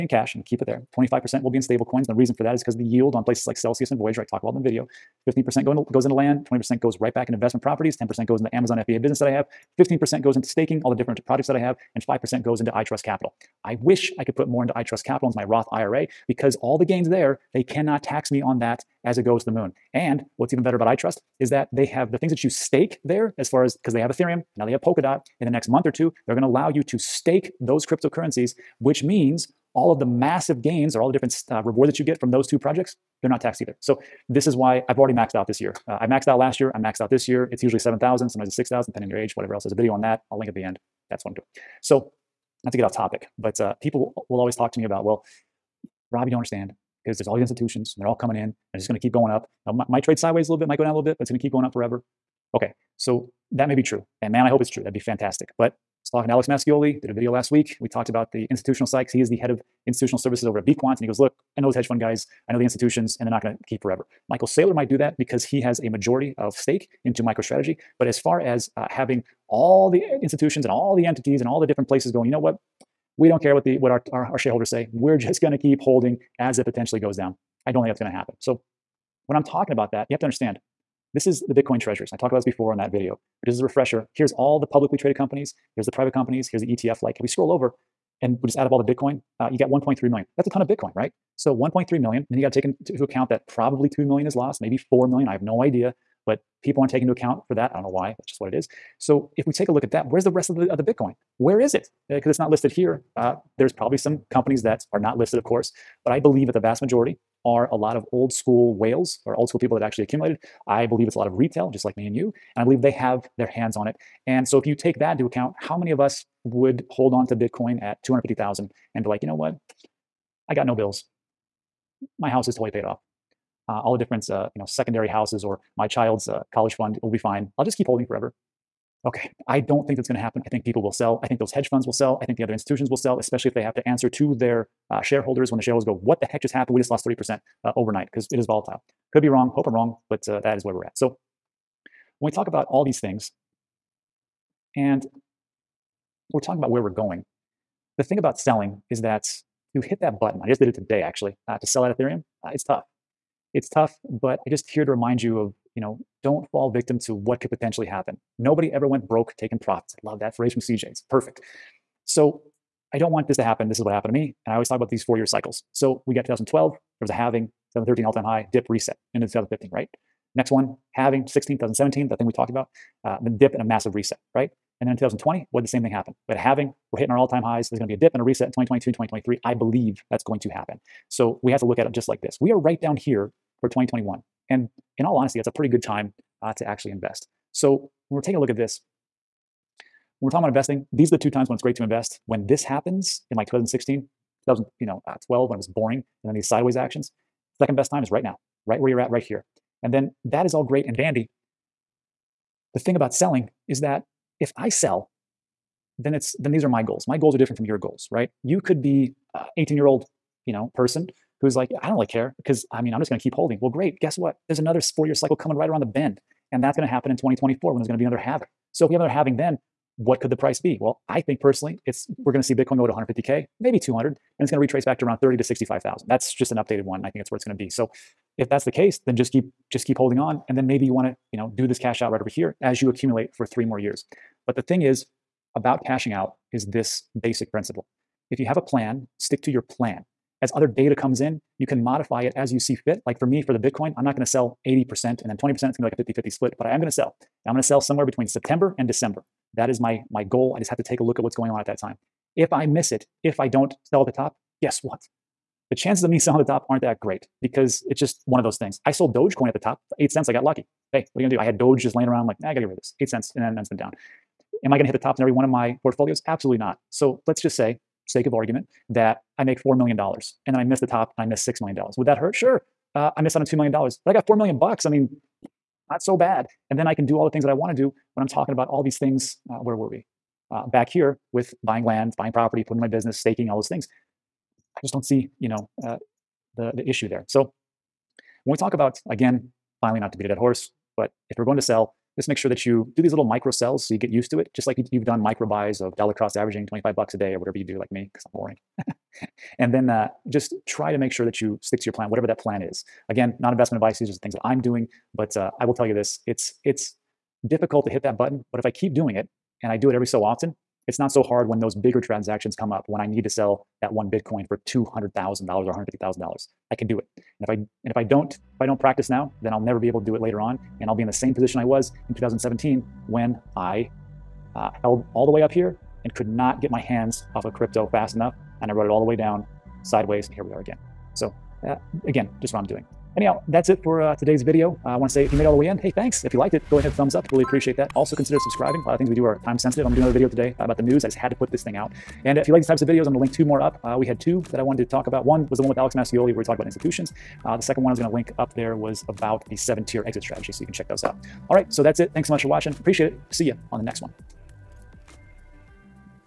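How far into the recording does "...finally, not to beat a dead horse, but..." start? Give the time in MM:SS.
04:49.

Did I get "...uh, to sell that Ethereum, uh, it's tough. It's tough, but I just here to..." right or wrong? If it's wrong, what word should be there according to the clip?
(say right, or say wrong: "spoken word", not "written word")
right.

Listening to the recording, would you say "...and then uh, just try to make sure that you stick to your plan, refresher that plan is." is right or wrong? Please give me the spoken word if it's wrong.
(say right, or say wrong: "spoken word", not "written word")
wrong: "whatever", not "refresher".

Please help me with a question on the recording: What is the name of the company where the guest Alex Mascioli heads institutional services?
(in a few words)
BeQuant.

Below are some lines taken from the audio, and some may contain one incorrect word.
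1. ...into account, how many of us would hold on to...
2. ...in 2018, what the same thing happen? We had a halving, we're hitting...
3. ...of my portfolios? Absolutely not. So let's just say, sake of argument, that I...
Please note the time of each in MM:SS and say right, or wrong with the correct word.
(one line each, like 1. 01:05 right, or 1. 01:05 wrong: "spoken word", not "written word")
1. 01:55 right
2. 02:54 wrong: "2020", not "2018"
3. 04:25 right.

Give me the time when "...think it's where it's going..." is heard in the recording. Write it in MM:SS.
03:47.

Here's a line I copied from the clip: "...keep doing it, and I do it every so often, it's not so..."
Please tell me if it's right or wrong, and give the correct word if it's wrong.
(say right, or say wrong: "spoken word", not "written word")
right.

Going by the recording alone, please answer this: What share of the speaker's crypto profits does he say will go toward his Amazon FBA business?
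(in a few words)
10%.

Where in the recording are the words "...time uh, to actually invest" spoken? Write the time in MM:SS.
03:05.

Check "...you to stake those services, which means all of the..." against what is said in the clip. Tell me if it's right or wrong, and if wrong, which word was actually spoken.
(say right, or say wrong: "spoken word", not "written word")
wrong: "cryptocurrencies", not "services".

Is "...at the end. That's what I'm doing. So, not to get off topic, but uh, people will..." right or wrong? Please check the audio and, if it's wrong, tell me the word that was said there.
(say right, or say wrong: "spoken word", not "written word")
right.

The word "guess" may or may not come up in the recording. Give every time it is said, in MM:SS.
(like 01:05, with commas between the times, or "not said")
03:33, 04:14.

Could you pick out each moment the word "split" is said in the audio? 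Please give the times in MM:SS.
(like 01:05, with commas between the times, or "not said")
04:06.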